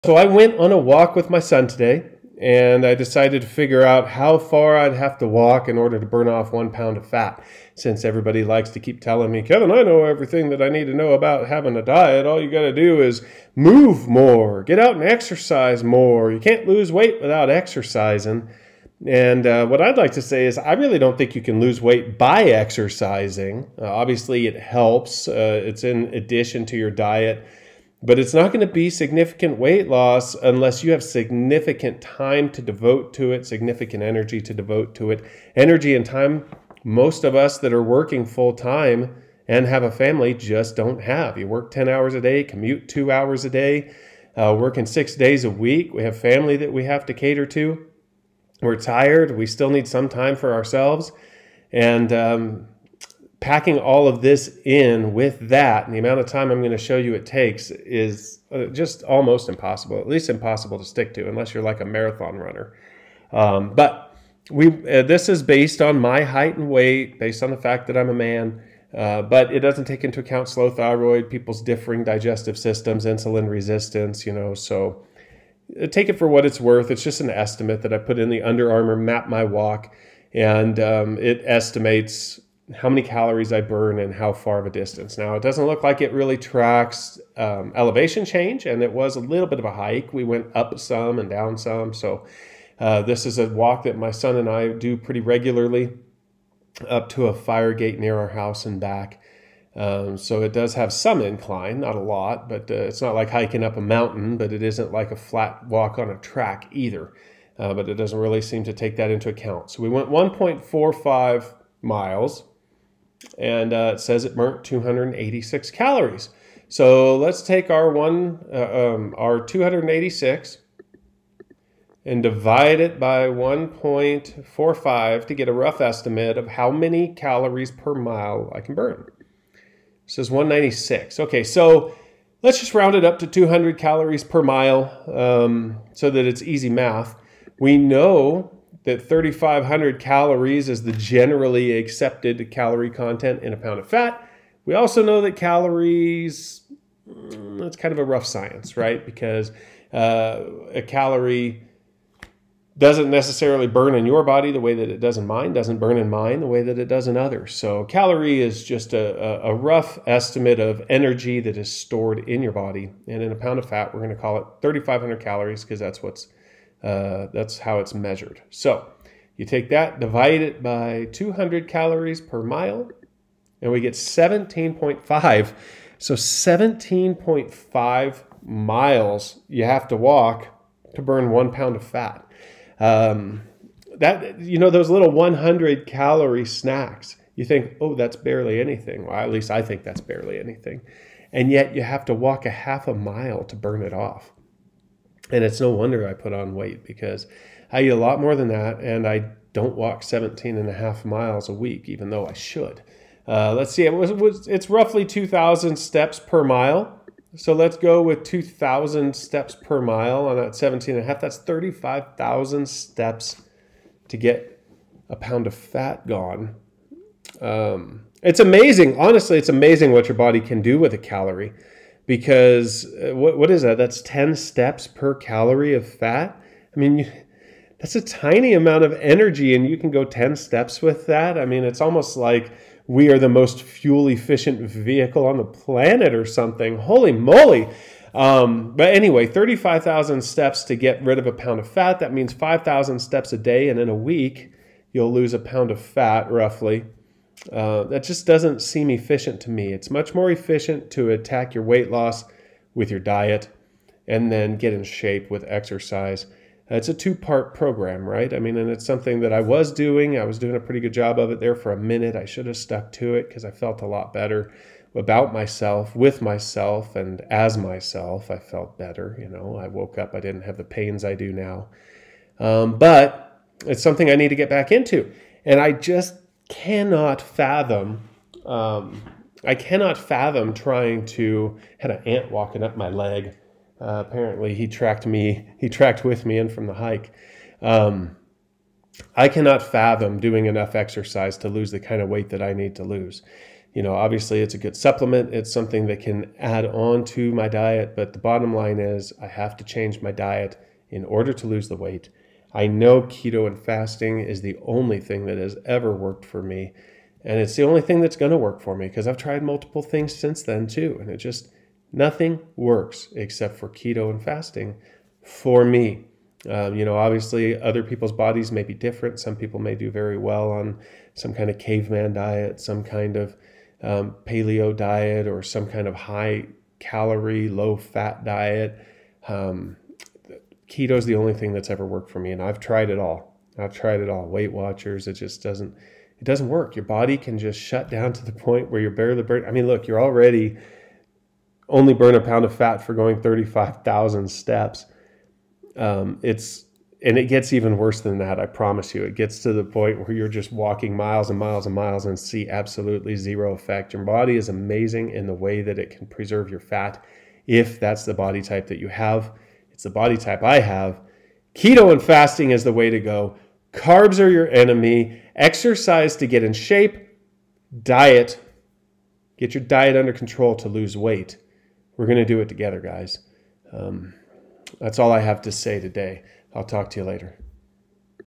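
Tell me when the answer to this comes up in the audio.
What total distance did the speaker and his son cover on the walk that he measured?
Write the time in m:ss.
1:50.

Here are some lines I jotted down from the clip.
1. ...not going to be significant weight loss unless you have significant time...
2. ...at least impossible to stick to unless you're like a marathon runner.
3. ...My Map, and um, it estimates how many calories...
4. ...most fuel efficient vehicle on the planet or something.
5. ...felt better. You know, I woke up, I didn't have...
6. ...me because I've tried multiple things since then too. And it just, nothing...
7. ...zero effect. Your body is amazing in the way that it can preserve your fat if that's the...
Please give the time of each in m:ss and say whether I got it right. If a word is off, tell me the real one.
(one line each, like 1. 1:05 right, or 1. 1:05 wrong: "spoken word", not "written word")
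1. 0:28 right
2. 0:59 right
3. 1:19 wrong: "Walk", not "Map"
4. 3:53 right
5. 4:28 right
6. 5:08 right
7. 5:53 right.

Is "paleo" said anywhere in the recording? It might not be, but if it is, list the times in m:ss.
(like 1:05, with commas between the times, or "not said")
5:24.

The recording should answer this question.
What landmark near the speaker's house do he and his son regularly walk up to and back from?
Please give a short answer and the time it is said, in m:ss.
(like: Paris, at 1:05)
a fire gate, at 1:37.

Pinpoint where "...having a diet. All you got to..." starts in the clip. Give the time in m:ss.
0:11.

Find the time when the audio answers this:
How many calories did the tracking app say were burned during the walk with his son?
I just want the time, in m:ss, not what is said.
1:54.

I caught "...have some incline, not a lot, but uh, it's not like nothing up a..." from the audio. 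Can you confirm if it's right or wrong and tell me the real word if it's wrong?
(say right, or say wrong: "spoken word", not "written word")
wrong: "hiking", not "nothing".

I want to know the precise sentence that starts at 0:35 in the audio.
Energy and time, most of us that are working full time and have a family just don't have.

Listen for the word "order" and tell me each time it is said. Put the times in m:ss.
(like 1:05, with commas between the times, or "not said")
0:05, 5:01.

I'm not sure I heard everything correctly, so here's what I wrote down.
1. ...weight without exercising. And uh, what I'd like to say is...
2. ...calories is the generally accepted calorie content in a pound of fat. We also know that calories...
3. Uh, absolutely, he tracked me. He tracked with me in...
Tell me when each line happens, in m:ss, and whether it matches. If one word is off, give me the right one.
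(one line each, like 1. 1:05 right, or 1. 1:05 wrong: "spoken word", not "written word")
1. 0:16 right
2. 2:19 right
3. 4:43 wrong: "apparently", not "absolutely".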